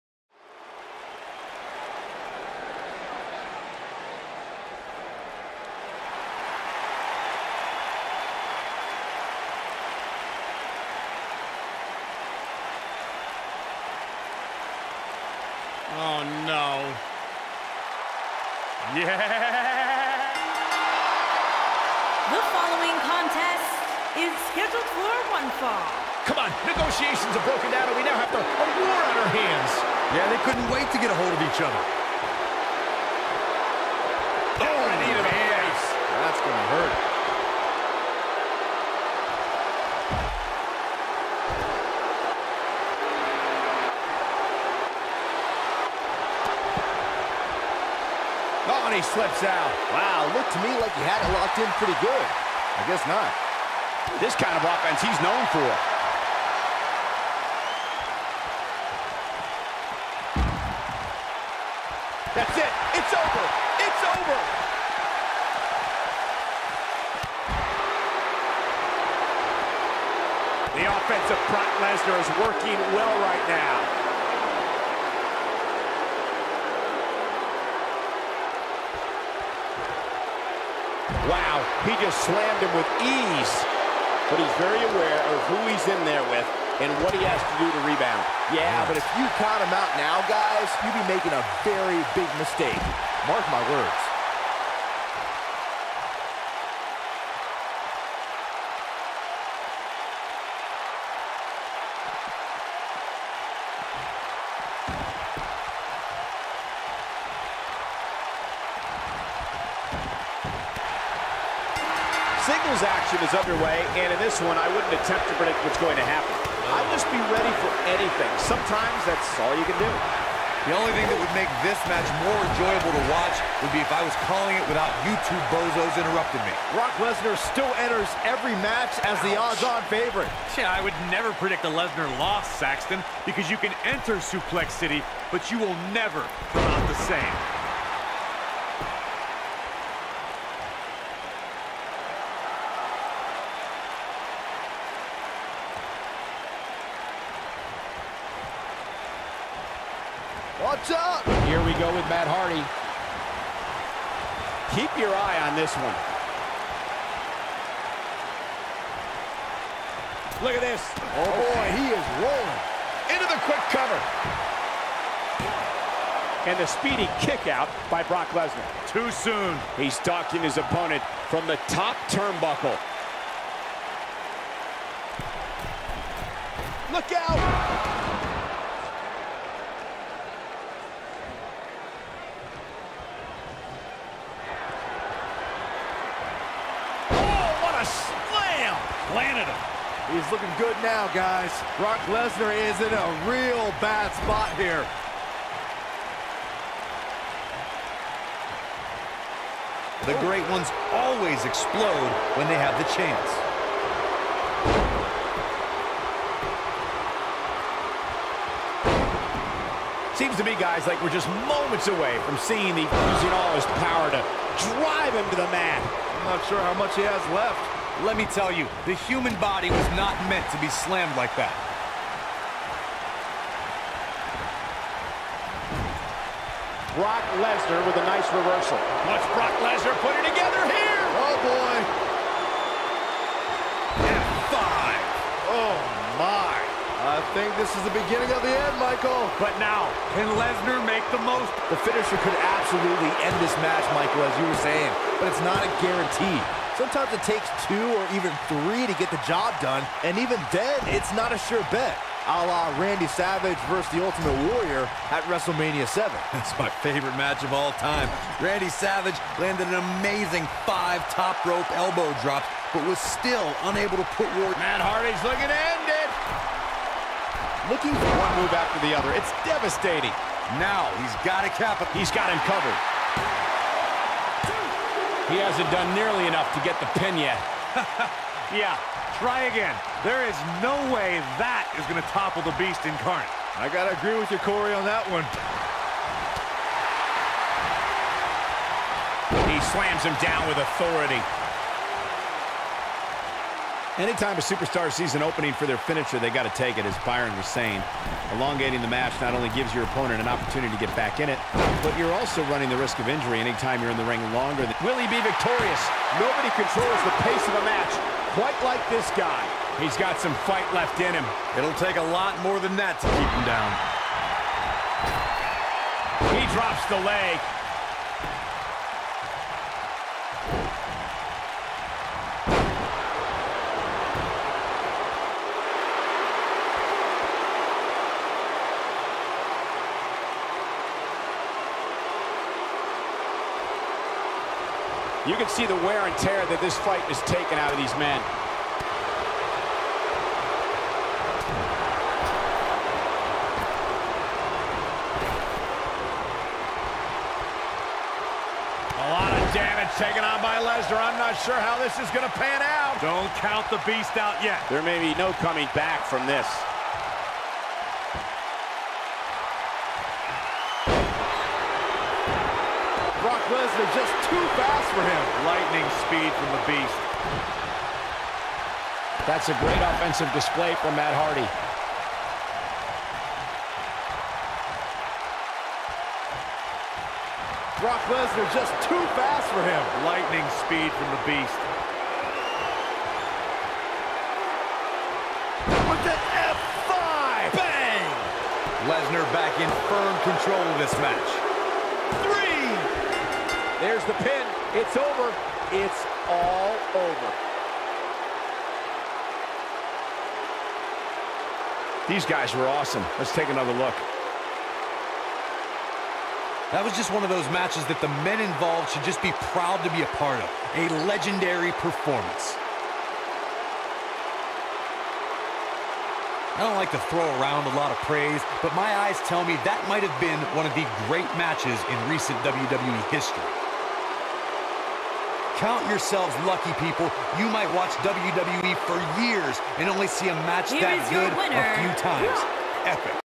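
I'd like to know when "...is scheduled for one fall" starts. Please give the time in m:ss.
0:24.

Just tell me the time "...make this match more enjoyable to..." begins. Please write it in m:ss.
2:01.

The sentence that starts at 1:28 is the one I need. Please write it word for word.
Yeah, but if you count him out now, guys, you'd be making a very big mistake.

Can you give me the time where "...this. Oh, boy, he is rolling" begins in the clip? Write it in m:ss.
2:40.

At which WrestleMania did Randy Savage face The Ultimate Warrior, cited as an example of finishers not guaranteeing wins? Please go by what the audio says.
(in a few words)
WrestleMania 7.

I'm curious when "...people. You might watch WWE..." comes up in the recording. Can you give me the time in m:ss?
7:06.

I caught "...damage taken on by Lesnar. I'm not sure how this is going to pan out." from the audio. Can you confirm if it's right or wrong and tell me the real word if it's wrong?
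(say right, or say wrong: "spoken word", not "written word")
right.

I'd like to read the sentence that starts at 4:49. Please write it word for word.
He slams him down with authority.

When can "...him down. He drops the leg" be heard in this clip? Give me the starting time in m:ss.
5:13.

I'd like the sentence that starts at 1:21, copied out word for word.
Wow, he just slammed him with ease.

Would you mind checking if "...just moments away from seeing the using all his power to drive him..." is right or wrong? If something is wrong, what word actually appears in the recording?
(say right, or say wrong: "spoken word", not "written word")
right.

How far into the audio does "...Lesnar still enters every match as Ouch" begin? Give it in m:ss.
2:07.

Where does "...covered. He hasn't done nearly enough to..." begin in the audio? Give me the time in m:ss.
4:32.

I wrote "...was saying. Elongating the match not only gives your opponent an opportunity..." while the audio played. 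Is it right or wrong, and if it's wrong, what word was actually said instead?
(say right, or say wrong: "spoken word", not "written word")
right.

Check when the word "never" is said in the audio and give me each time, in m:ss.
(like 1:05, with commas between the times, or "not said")
2:11, 2:15.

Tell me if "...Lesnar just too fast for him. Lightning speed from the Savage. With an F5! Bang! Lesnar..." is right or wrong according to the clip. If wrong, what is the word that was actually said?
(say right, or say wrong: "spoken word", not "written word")
wrong: "Beast", not "Savage".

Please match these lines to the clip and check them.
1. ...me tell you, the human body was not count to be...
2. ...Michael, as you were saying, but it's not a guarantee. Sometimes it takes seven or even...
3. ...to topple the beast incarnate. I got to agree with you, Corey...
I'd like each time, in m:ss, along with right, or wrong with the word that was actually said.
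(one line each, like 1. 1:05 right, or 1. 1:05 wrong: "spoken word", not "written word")
1. 3:38 wrong: "meant", not "count"
2. 4:03 wrong: "two", not "seven"
3. 4:42 right.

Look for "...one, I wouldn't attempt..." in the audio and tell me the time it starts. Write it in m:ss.
1:54.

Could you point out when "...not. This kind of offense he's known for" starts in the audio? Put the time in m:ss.
0:53.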